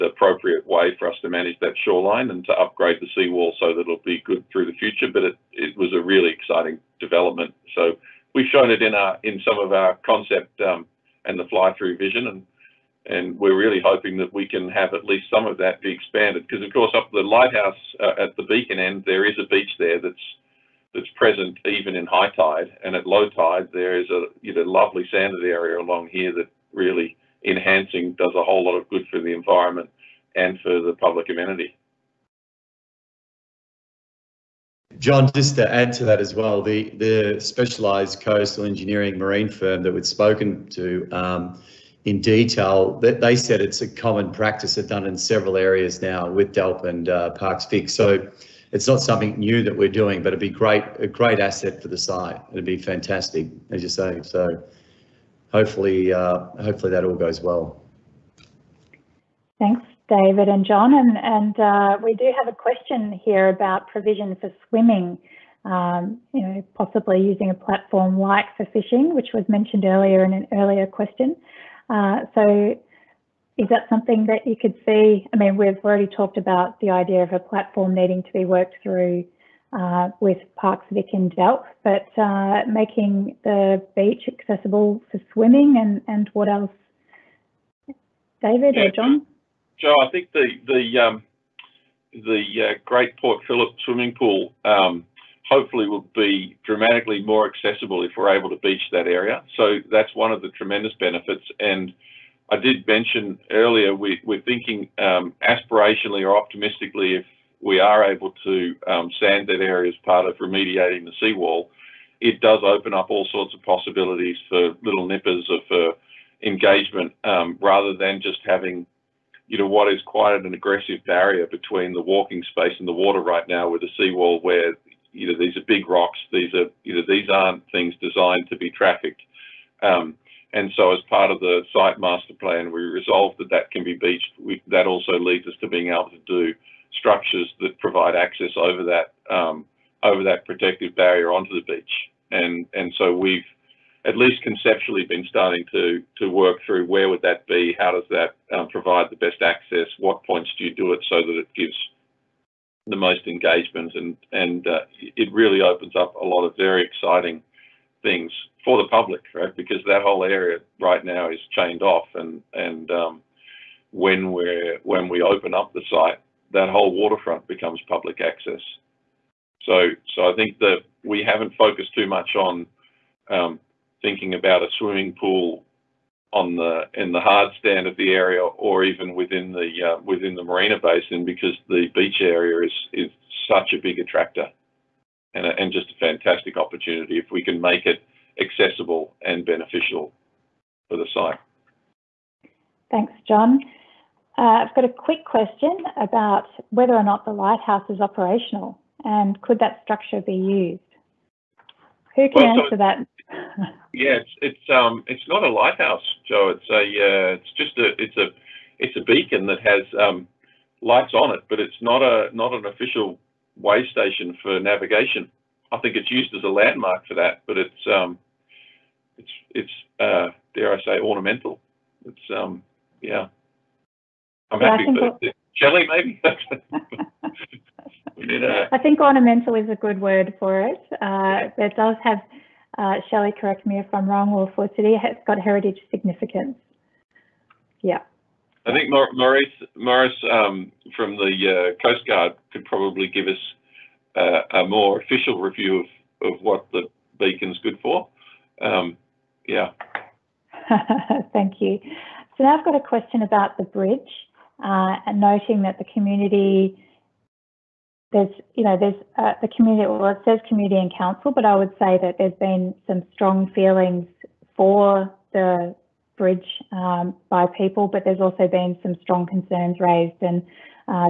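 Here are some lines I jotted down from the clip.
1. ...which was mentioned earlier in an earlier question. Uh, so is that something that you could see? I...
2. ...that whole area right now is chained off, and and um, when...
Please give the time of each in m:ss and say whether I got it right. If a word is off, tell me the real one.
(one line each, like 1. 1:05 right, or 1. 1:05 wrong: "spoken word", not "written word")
1. 1:09 right
2. 2:39 right.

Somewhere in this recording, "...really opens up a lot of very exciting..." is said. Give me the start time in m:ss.
2:35.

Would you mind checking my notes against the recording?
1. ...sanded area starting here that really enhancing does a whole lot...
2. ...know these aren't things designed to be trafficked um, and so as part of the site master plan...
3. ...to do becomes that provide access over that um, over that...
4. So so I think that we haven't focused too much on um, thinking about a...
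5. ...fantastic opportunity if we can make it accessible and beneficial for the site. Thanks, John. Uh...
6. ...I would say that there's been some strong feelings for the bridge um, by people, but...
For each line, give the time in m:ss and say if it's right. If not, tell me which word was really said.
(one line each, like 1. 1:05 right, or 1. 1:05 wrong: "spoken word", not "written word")
1. 0:25 wrong: "along", not "starting"
2. 2:06 right
3. 2:16 wrong: "structures", not "becomes"
4. 2:49 right
5. 3:05 right
6. 4:21 right.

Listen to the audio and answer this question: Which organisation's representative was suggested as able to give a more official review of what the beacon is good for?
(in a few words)
Coast Guard.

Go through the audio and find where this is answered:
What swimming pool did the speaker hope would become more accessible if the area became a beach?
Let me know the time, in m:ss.
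1:32.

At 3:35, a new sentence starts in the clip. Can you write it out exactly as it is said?
I think it's used as a landmark for that, but it's um, it's it's uh, dare I say ornamental.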